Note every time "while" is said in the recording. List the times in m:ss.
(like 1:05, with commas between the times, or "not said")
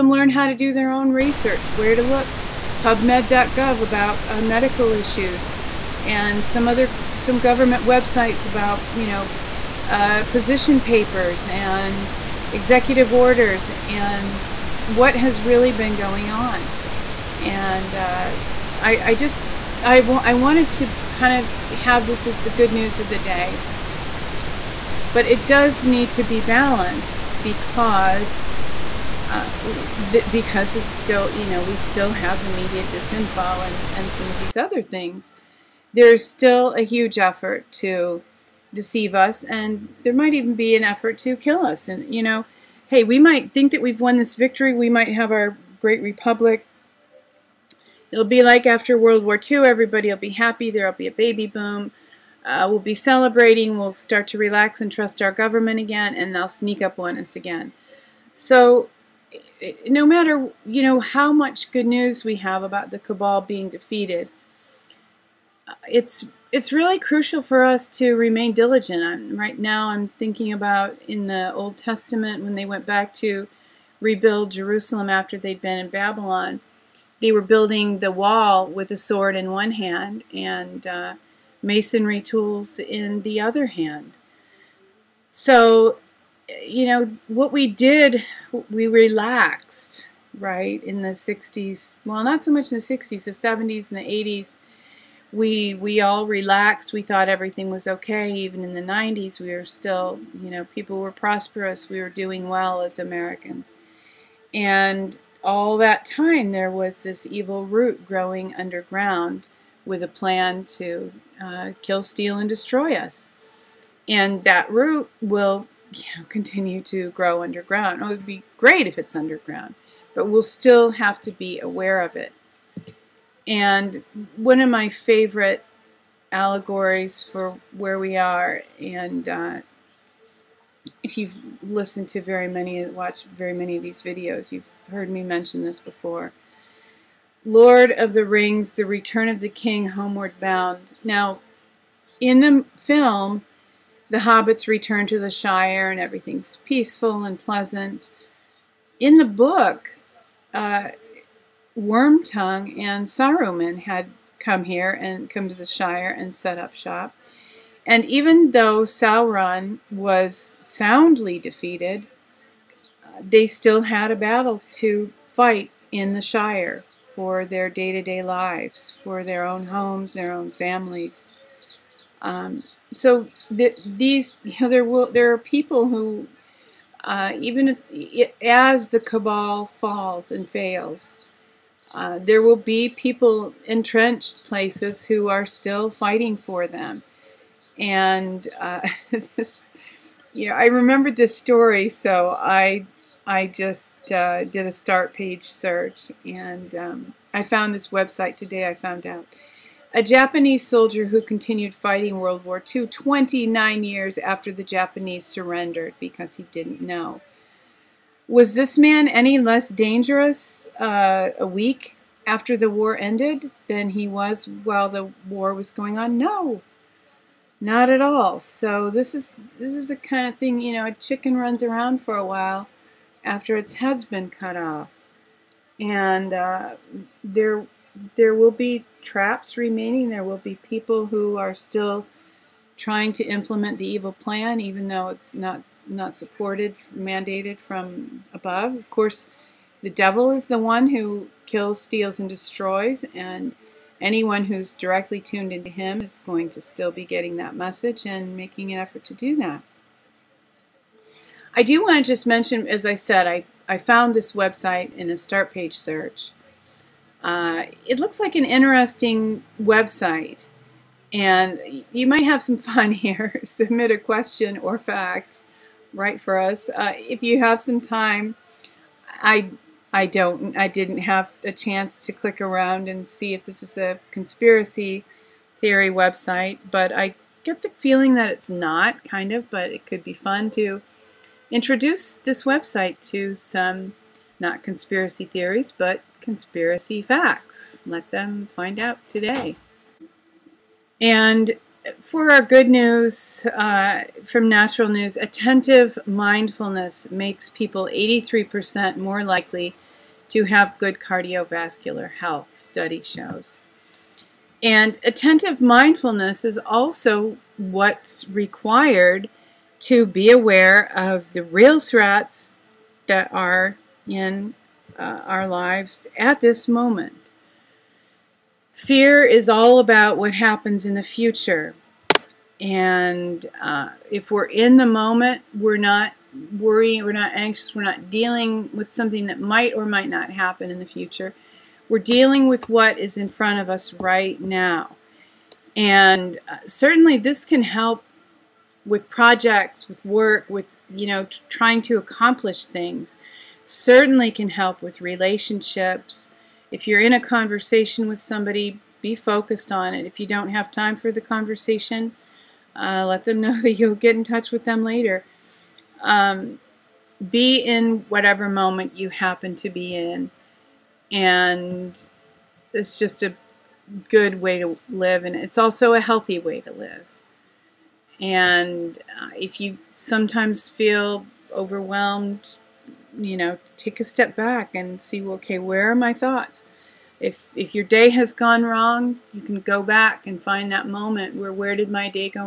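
3:34, 3:42.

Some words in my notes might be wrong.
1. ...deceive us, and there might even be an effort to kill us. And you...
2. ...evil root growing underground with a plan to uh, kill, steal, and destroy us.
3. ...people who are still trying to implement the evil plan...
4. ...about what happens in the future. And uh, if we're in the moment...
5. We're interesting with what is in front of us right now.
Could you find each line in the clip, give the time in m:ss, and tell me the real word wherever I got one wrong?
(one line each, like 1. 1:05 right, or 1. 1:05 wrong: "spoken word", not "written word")
1. 0:38 right
2. 1:47 right
3. 3:50 right
4. 5:19 right
5. 5:31 wrong: "dealing", not "interesting".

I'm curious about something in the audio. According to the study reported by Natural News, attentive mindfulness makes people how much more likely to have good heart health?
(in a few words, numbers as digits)
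83%.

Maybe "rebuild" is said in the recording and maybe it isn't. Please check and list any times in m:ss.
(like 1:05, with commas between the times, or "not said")
1:13.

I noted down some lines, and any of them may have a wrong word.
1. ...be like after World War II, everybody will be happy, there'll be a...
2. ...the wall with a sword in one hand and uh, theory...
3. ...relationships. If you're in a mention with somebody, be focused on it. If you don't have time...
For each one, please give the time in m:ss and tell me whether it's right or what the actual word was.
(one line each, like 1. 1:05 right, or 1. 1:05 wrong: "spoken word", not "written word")
1. 0:48 right
2. 1:17 wrong: "masonry", not "theory"
3. 5:45 wrong: "conversation", not "mention".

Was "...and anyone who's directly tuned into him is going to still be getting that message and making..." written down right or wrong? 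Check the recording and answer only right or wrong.
right.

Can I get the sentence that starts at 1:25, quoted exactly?
So, you know, what we did, we relaxed, right, in the 60s.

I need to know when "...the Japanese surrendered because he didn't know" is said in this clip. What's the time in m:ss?
3:24.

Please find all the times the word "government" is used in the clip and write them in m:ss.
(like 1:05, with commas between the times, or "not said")
0:07, 0:55.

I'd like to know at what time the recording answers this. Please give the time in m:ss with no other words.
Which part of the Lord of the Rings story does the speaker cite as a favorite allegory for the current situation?
2:18.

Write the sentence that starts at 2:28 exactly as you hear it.
In the book, uh, Wormtongue and Saruman had come here and come to the Shire and set up shop.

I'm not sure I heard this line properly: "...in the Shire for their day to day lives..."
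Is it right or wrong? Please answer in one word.
right.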